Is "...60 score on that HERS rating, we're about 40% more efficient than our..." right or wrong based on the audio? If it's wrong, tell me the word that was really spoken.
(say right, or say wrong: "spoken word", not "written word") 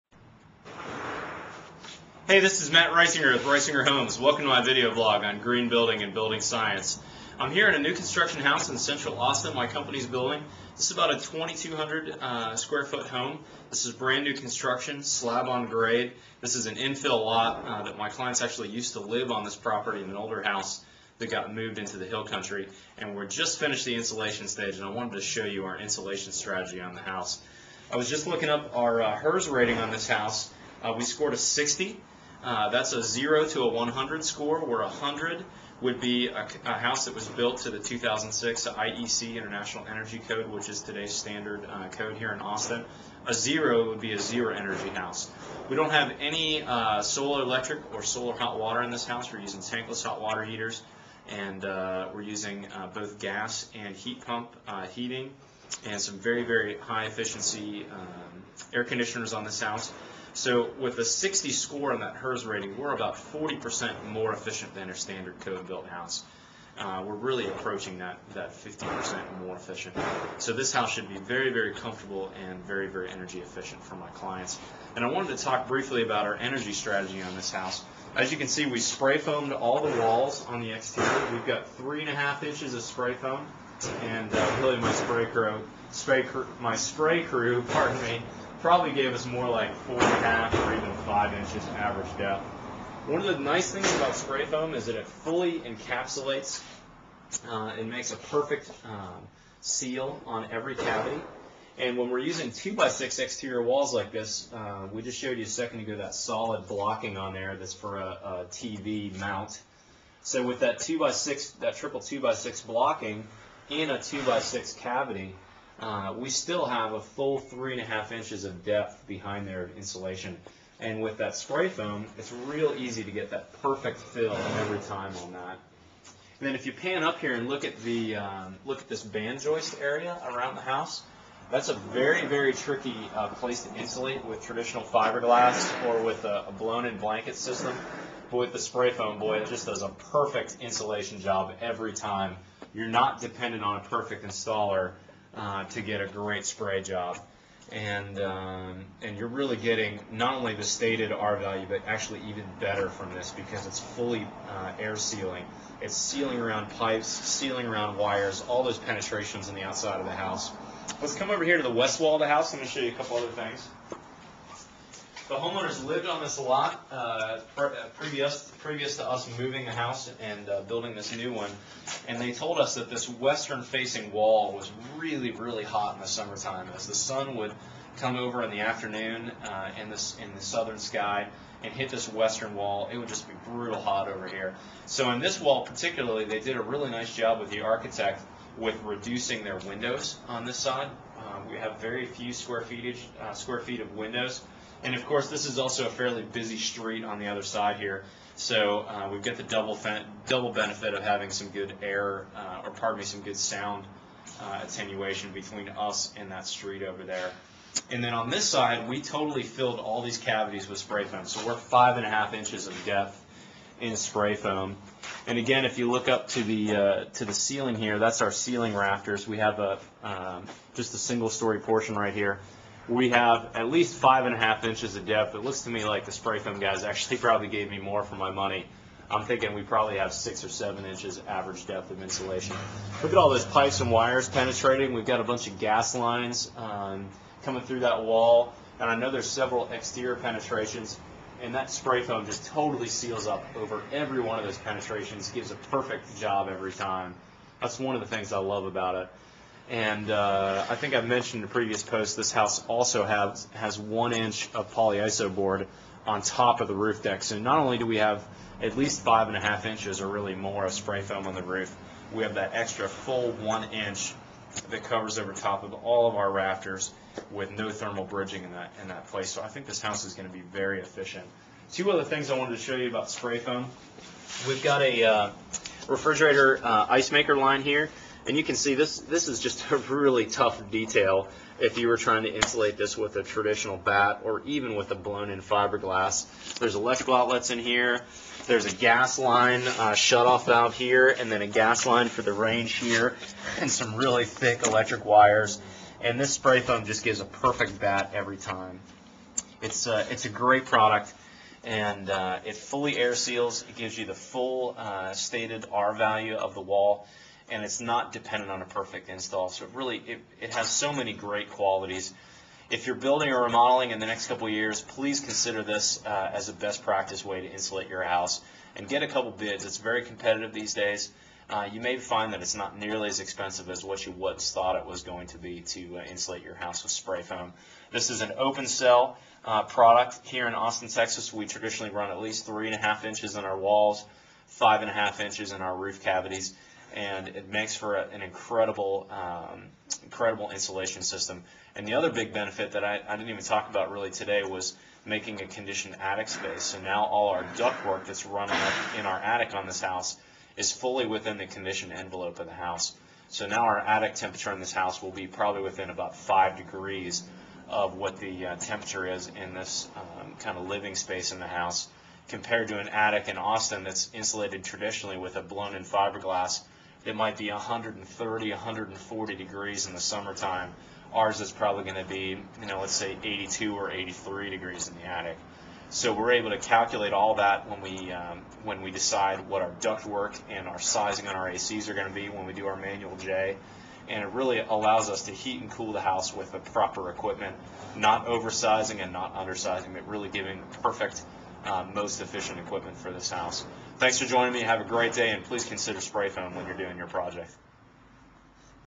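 right.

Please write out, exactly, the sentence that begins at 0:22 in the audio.
And we're just finished the insulation stage, and I wanted to show you our insulation strategy on the house.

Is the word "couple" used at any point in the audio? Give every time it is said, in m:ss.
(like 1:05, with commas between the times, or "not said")
2:42, 5:14, 5:19.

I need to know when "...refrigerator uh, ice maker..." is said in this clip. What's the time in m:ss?
4:35.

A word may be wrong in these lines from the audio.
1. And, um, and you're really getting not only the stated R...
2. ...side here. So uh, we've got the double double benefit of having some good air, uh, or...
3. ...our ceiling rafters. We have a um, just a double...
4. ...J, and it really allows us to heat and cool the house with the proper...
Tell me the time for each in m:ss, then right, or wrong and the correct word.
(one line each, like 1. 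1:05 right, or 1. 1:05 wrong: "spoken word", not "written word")
1. 2:27 right
2. 3:17 right
3. 3:38 wrong: "single", not "double"
4. 6:23 right.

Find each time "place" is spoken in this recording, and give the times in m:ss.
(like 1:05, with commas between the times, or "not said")
2:13, 4:29.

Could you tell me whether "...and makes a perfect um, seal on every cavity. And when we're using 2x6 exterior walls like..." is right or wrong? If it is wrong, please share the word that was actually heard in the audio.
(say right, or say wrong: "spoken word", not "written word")
right.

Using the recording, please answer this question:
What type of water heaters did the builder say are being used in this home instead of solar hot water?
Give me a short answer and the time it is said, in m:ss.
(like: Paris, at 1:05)
tankless, at 0:49.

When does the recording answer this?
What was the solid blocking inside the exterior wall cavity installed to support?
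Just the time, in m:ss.
1:48.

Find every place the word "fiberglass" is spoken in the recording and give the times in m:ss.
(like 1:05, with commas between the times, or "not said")
2:14, 4:45, 6:05.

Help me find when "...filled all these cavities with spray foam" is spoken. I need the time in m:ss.
3:29.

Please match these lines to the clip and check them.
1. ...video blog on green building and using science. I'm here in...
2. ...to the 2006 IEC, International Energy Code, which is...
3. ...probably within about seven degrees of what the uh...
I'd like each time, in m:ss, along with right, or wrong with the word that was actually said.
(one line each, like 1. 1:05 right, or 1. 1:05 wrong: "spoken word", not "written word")
1. 0:04 wrong: "building", not "using"
2. 0:37 right
3. 5:55 wrong: "five", not "seven".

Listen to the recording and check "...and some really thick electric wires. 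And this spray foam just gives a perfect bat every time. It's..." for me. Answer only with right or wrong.
right.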